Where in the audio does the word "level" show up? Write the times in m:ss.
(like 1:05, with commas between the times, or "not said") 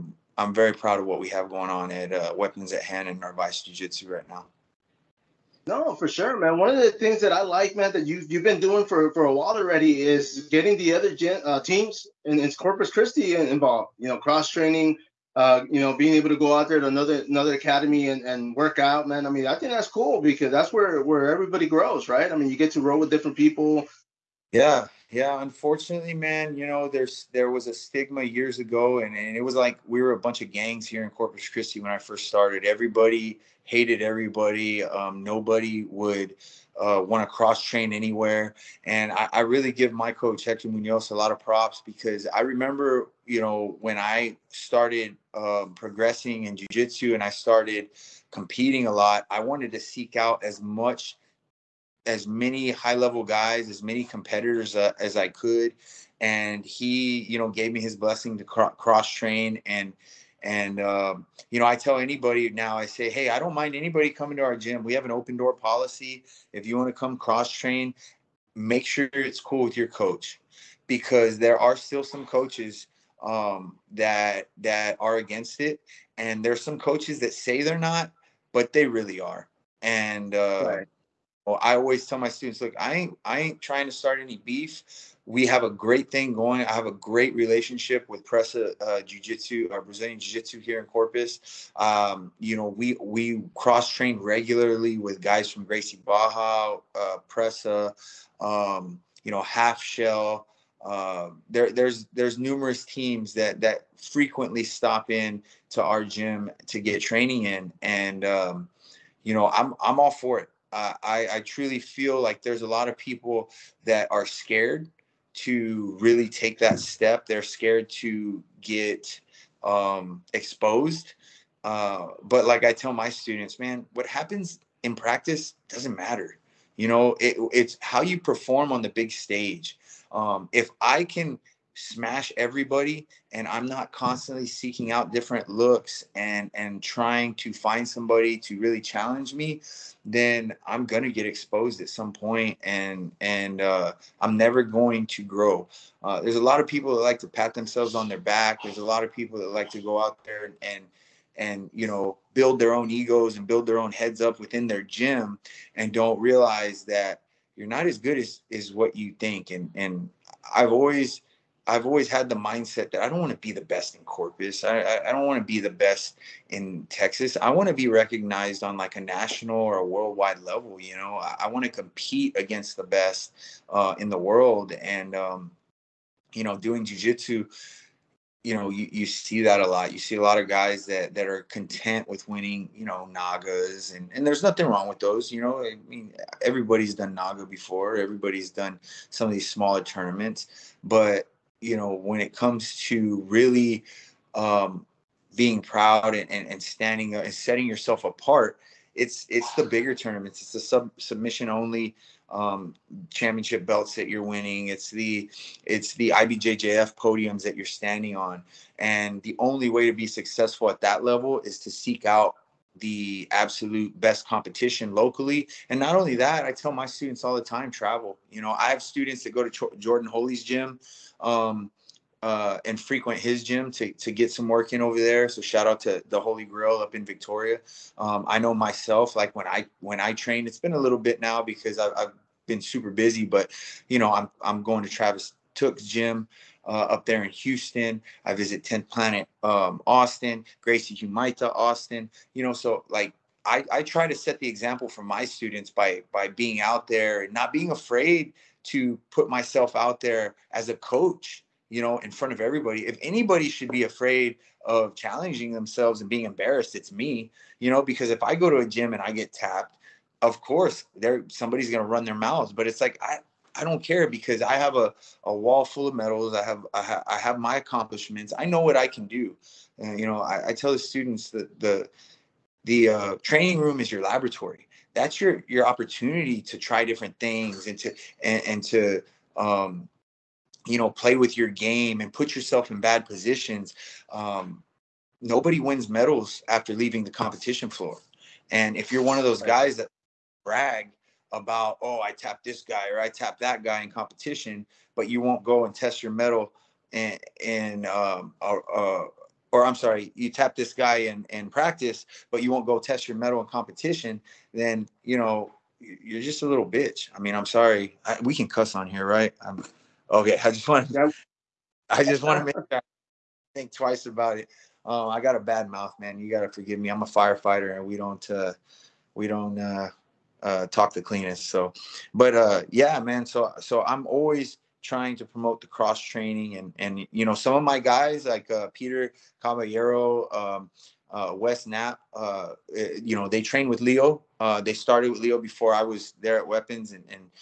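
0:52, 2:50, 3:31.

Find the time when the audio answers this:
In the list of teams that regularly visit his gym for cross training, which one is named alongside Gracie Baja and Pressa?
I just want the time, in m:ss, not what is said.
1:39.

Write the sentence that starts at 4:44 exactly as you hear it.
Um, nobody wins medals after leaving the competition floor.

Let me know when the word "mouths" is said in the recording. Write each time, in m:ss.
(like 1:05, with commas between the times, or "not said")
4:22, 5:15.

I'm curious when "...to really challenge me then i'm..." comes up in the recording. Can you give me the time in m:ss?
2:18.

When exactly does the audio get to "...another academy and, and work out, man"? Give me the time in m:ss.
0:17.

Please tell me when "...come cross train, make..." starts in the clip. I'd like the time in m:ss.
1:06.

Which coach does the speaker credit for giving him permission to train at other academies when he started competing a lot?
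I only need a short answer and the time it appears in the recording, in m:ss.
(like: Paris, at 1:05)
Hector Munoz, at 0:40.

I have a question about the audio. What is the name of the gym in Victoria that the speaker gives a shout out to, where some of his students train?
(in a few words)
the Holy Grail.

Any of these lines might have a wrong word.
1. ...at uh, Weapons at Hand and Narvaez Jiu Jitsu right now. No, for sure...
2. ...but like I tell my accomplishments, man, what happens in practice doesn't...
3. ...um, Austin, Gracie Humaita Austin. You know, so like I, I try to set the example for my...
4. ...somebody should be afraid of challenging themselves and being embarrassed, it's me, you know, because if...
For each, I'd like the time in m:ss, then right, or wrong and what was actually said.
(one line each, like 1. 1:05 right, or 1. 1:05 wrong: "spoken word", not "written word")
1. 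0:01 right
2. 2:02 wrong: "students", not "accomplishments"
3. 3:59 right
4. 4:13 wrong: "anybody", not "somebody".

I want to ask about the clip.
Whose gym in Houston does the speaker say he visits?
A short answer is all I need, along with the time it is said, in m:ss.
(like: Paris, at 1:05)
Travis Tooke, at 3:54.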